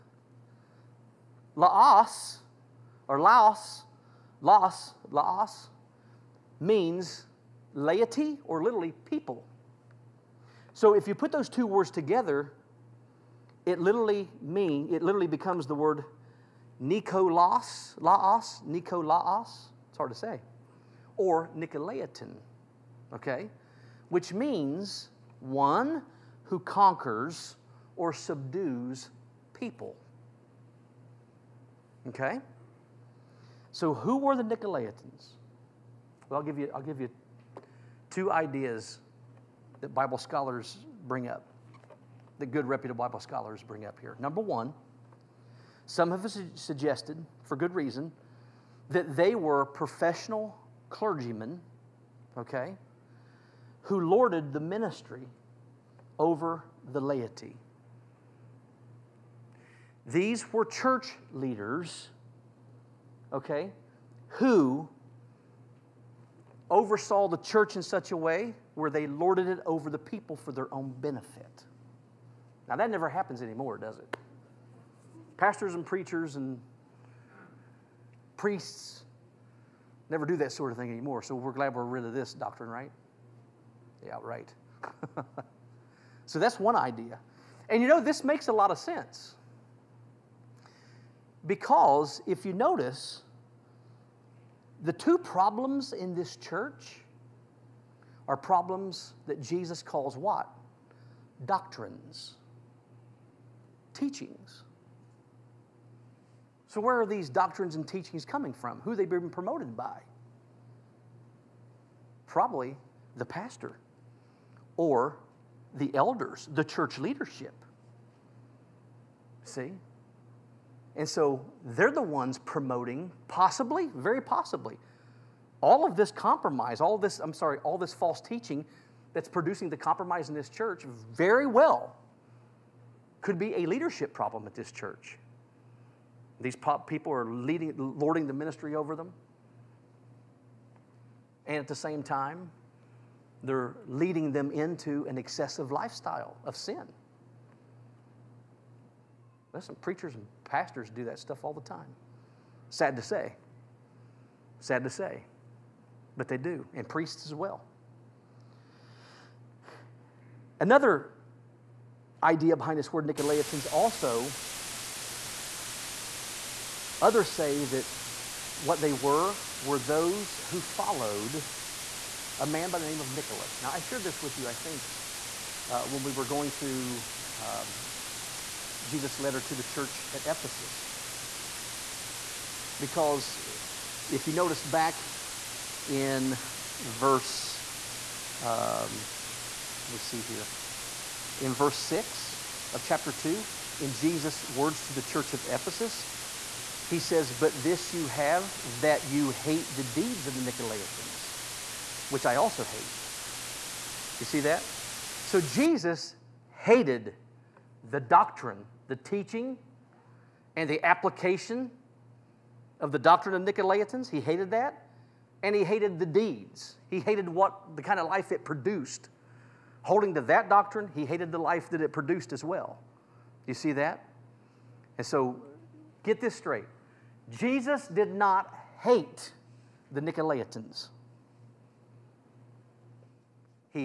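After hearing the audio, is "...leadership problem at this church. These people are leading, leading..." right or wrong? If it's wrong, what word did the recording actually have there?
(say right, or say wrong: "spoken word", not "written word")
wrong: "lording", not "leading".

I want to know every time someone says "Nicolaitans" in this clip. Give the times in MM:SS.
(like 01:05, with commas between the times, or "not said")
00:21, 00:34, 02:43, 03:20, 03:33, 03:49.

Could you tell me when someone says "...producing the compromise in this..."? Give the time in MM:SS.
02:09.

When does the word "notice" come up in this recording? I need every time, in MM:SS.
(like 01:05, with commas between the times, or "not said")
01:32, 03:04.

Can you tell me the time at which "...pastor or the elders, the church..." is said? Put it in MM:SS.
01:53.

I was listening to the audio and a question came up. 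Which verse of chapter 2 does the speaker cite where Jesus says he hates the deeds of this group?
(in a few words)
verse 6.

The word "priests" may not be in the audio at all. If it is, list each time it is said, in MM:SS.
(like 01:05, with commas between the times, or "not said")
01:18, 02:36.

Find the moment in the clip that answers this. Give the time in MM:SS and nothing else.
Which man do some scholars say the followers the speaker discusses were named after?
02:53.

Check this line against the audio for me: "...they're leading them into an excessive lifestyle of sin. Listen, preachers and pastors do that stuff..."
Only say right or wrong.
right.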